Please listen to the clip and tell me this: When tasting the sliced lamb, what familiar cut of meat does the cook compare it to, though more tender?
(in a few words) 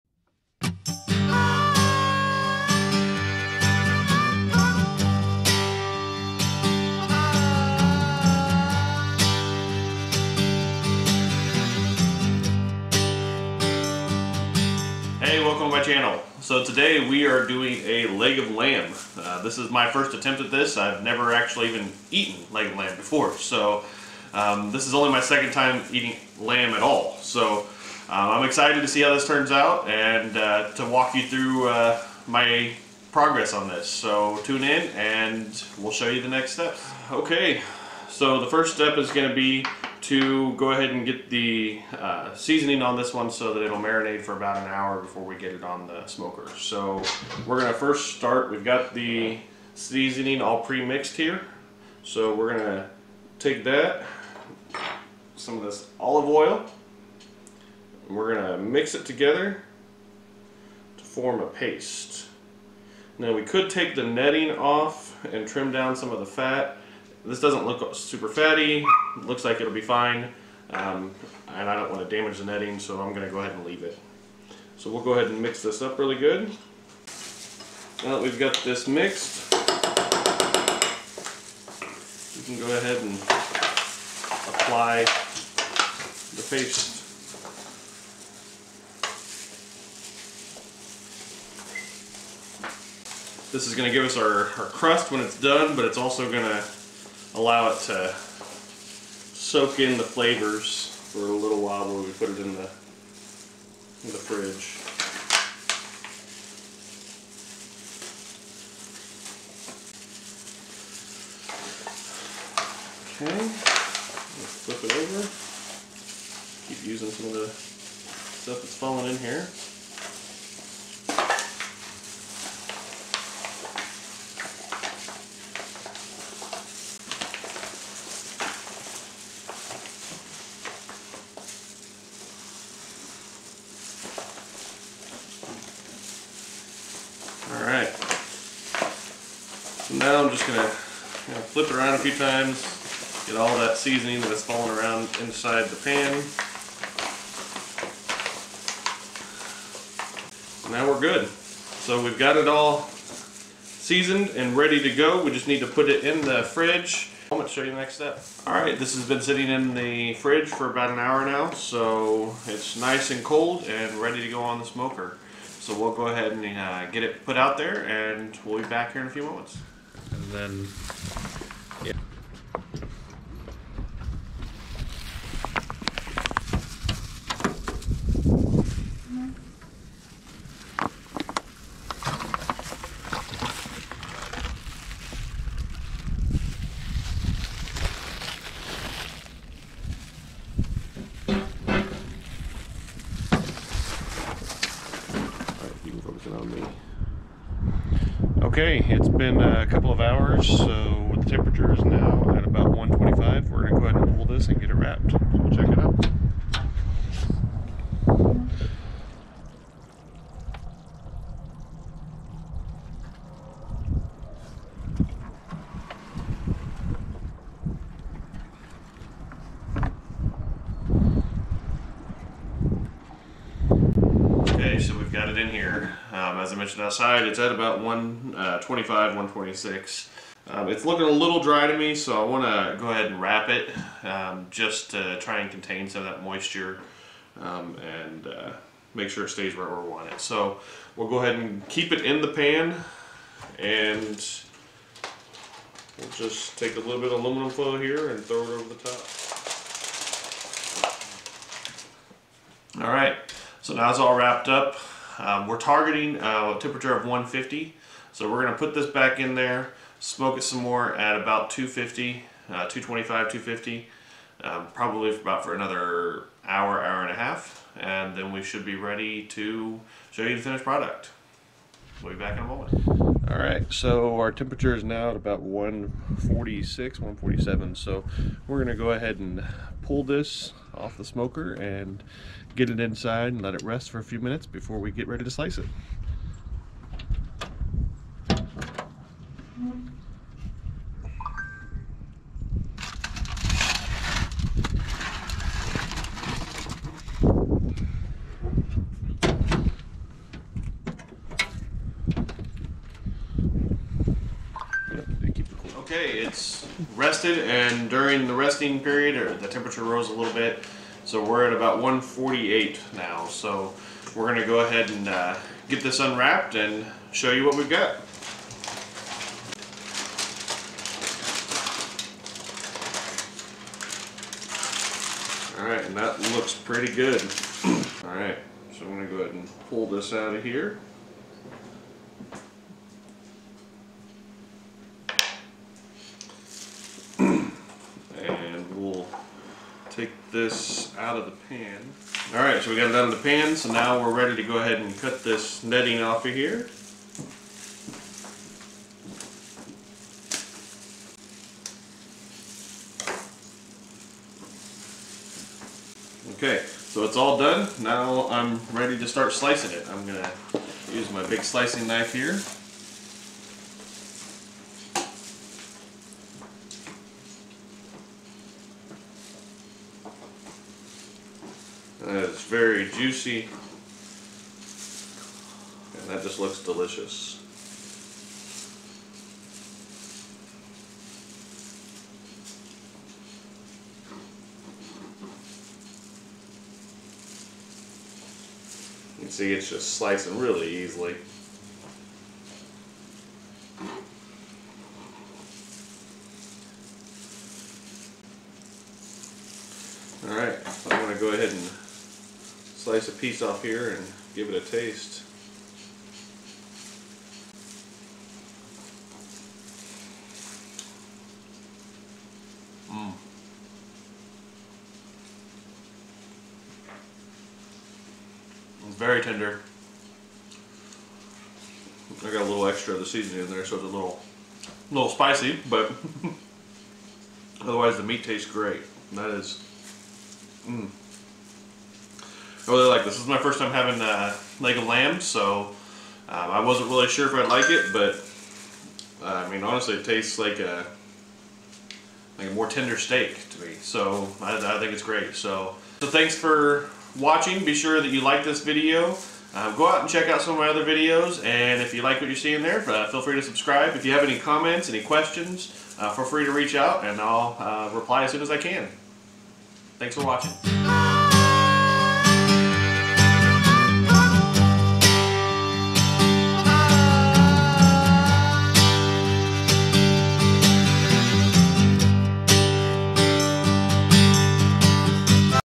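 steak.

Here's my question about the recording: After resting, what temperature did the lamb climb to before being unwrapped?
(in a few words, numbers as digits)
148.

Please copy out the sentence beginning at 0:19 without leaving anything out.
Uh, this is my first attempt at this.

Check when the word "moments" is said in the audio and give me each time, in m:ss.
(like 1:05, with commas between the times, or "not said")
2:49, 4:32.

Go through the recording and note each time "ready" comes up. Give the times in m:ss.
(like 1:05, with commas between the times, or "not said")
2:34, 2:43, 4:28, 4:45, 5:44, 5:58.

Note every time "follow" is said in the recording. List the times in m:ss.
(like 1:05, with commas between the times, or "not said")
not said.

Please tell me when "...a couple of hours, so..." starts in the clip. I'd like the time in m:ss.
3:19.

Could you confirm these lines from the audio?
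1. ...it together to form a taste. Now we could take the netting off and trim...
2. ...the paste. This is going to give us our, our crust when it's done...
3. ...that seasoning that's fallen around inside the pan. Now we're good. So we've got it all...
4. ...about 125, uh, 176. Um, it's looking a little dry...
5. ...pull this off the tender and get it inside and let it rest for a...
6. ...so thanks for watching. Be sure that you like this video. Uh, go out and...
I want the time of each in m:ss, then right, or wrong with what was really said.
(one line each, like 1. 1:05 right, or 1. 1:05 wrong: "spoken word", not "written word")
1. 0:58 wrong: "paste", not "taste"
2. 1:25 right
3. 2:23 right
4. 3:47 wrong: "126", not "176"
5. 4:39 wrong: "smoker", not "tender"
6. 7:26 right.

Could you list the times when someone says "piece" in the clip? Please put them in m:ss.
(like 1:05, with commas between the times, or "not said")
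6:43.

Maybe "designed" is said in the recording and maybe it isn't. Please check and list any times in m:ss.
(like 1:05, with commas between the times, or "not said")
not said.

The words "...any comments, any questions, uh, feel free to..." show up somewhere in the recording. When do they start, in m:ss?
7:34.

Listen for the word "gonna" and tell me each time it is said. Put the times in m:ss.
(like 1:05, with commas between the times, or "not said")
2:20, 2:37, 4:38, 5:14.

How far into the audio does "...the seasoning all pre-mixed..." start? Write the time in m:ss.
0:48.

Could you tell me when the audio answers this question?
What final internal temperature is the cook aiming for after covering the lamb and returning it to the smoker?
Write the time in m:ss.
4:17.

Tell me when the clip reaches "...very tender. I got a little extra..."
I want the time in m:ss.
6:58.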